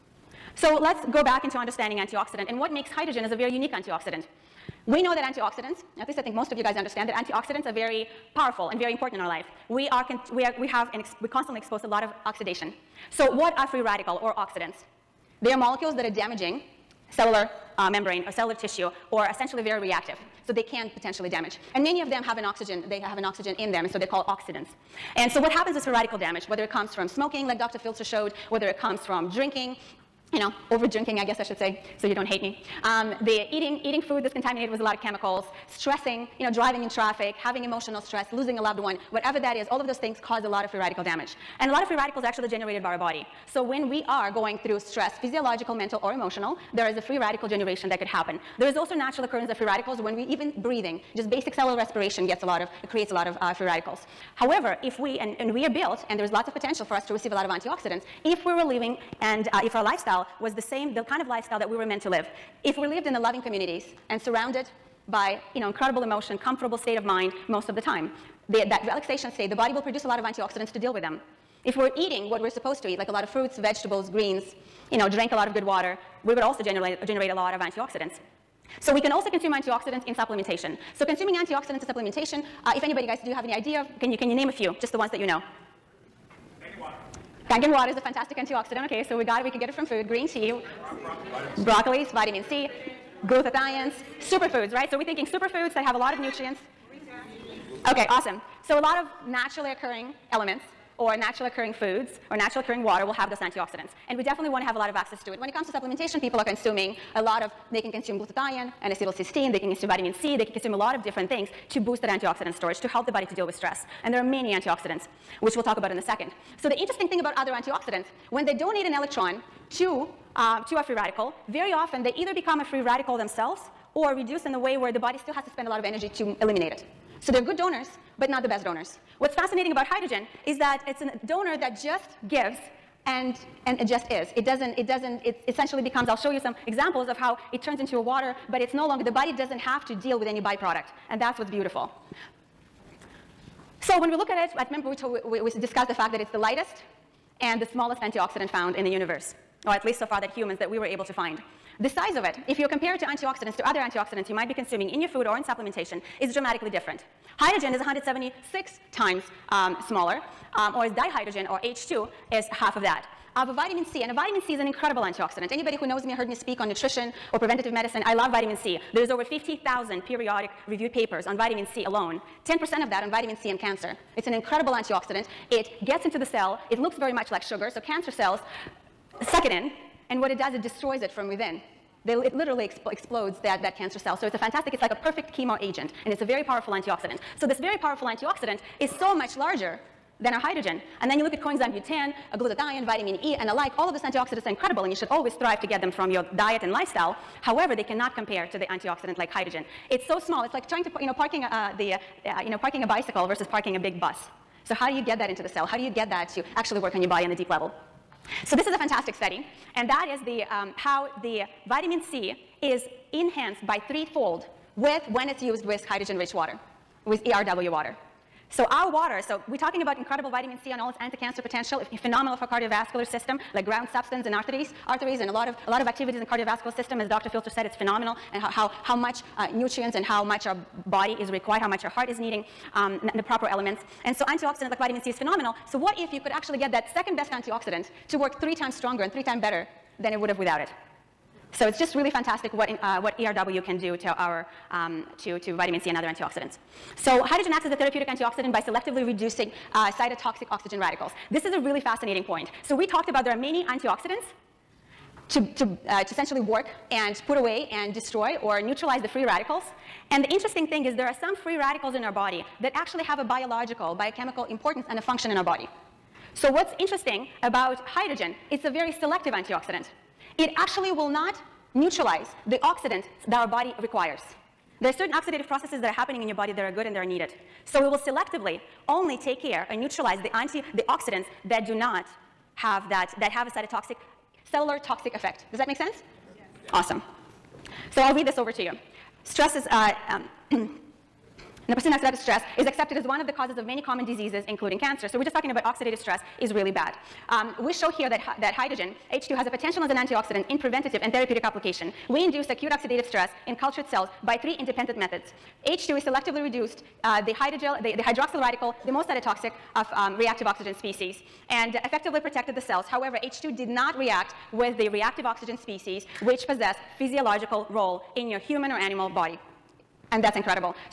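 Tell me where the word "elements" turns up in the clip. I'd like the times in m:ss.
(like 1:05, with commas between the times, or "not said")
1:40, 3:53.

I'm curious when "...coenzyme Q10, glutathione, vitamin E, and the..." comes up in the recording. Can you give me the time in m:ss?
3:11.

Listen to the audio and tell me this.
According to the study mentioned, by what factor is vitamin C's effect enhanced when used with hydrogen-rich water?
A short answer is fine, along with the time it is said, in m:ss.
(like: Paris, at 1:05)
Threefold, at 3:33.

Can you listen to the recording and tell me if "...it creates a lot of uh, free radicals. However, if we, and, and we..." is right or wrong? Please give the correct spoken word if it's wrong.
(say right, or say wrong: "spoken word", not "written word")
right.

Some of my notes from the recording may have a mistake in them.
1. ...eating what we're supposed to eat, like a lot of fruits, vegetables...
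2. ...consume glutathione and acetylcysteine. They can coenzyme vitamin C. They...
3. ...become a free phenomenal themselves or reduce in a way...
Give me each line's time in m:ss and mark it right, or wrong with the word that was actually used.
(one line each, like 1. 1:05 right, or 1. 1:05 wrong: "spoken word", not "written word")
1. 1:11 right
2. 1:47 wrong: "consume", not "coenzyme"
3. 2:02 wrong: "radical", not "phenomenal".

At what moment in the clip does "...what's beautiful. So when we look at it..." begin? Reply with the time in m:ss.
2:21.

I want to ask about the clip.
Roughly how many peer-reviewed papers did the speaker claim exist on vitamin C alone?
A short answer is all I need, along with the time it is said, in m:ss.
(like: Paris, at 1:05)
Over 50,000, at 2:49.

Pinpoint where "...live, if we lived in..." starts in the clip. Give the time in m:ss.
1:02.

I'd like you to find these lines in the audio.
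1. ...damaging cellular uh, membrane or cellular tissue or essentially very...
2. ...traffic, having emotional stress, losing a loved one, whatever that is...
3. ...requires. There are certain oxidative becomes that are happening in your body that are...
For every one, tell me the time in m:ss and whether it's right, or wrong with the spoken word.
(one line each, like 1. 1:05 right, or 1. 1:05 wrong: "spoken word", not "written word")
1. 0:16 right
2. 0:36 right
3. 4:33 wrong: "processes", not "becomes".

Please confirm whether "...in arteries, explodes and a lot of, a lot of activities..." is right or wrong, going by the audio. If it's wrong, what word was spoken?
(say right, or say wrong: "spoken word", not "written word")
wrong: "arteries", not "explodes".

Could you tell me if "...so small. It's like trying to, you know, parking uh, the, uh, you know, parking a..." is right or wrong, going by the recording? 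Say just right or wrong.
right.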